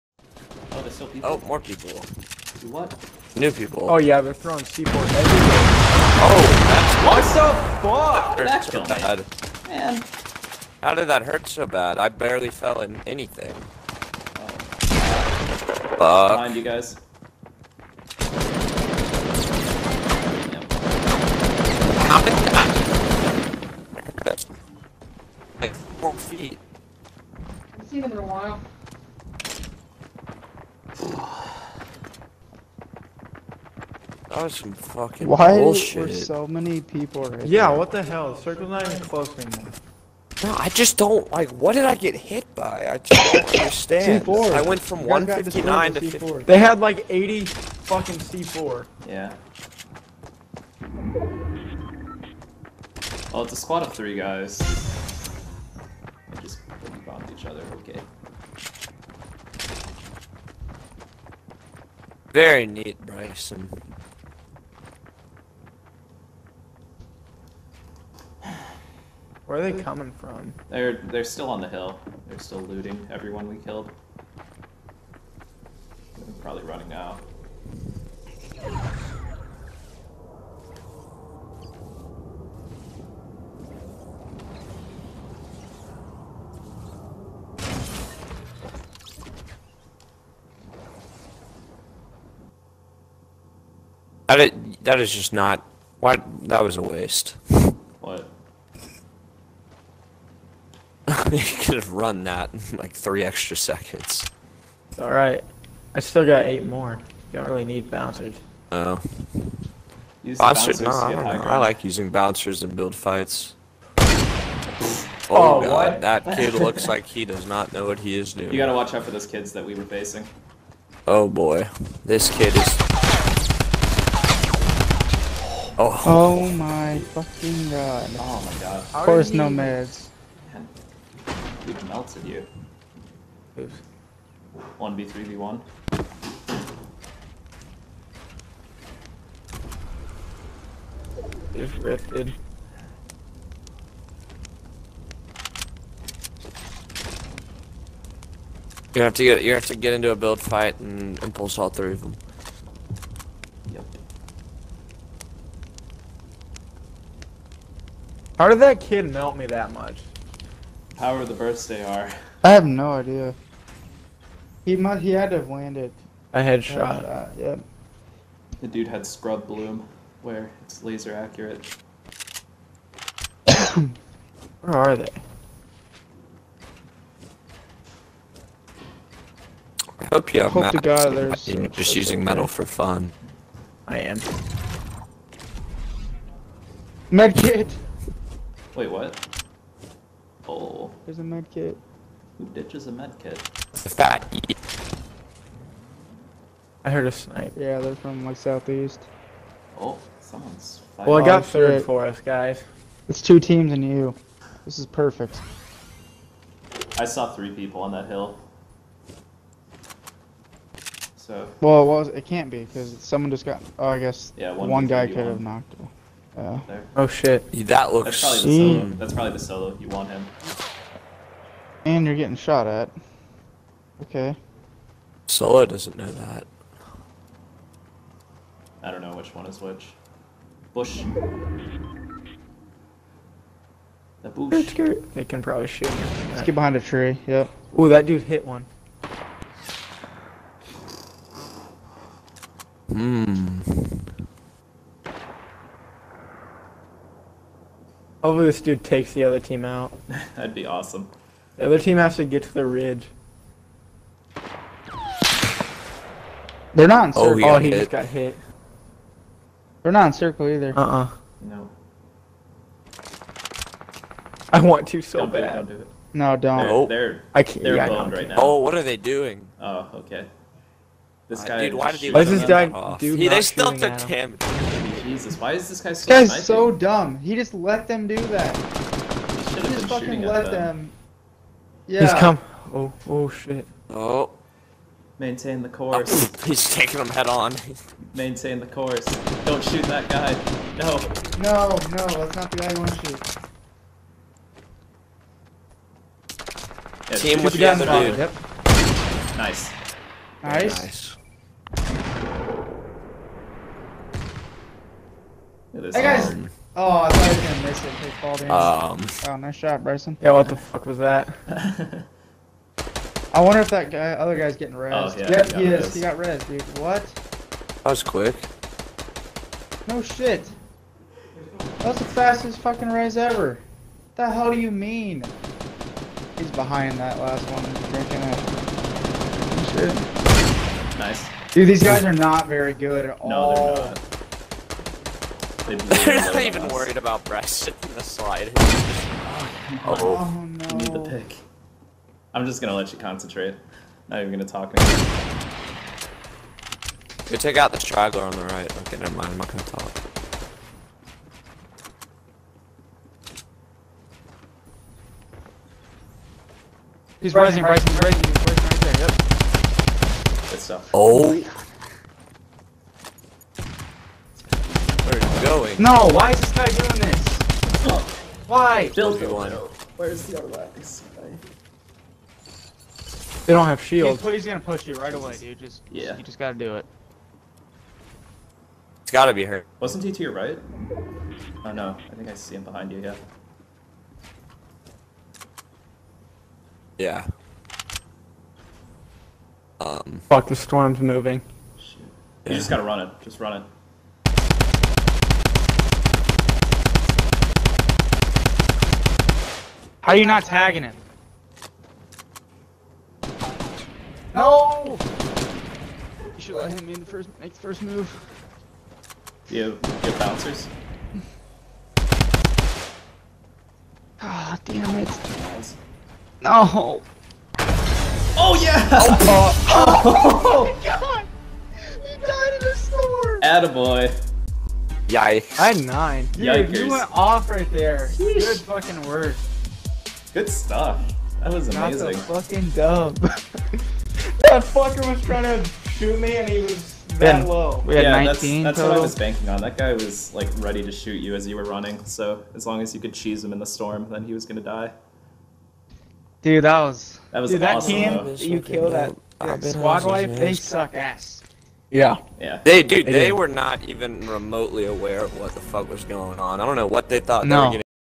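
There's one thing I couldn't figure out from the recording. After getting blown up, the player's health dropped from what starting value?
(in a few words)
159.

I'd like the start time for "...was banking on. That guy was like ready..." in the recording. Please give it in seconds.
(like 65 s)
439 s.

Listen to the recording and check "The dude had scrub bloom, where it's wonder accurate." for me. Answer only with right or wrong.
wrong.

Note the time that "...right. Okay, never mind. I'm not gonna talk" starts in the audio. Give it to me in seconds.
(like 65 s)
348 s.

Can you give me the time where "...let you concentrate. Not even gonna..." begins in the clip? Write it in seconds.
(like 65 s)
342 s.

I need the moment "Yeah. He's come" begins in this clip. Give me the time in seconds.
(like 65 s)
281 s.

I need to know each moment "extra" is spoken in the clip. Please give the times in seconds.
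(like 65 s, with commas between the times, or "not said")
103 s.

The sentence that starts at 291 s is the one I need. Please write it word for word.
No, no, that's not the guy you want to shoot.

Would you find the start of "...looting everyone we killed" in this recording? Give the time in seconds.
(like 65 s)
72 s.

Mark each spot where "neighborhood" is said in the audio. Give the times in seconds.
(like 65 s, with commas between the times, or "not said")
not said.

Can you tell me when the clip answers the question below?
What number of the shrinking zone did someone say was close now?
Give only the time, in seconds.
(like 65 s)
38 s.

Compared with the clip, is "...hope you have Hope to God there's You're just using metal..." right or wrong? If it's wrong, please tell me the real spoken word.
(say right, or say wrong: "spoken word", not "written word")
right.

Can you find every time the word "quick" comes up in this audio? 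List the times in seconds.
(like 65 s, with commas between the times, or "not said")
318 s.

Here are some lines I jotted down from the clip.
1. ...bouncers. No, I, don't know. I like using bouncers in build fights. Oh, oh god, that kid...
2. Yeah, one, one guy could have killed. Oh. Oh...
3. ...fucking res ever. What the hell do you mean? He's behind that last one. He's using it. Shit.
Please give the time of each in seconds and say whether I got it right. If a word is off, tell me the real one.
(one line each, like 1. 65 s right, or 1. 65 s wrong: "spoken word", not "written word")
1. 110 s right
2. 214 s wrong: "knocked", not "killed"
3. 322 s wrong: "drinking", not "using".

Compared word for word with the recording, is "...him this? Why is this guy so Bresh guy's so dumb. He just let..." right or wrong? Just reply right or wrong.
wrong.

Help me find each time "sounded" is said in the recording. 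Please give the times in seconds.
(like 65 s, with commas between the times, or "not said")
not said.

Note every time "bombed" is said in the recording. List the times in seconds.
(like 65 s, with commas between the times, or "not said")
57 s.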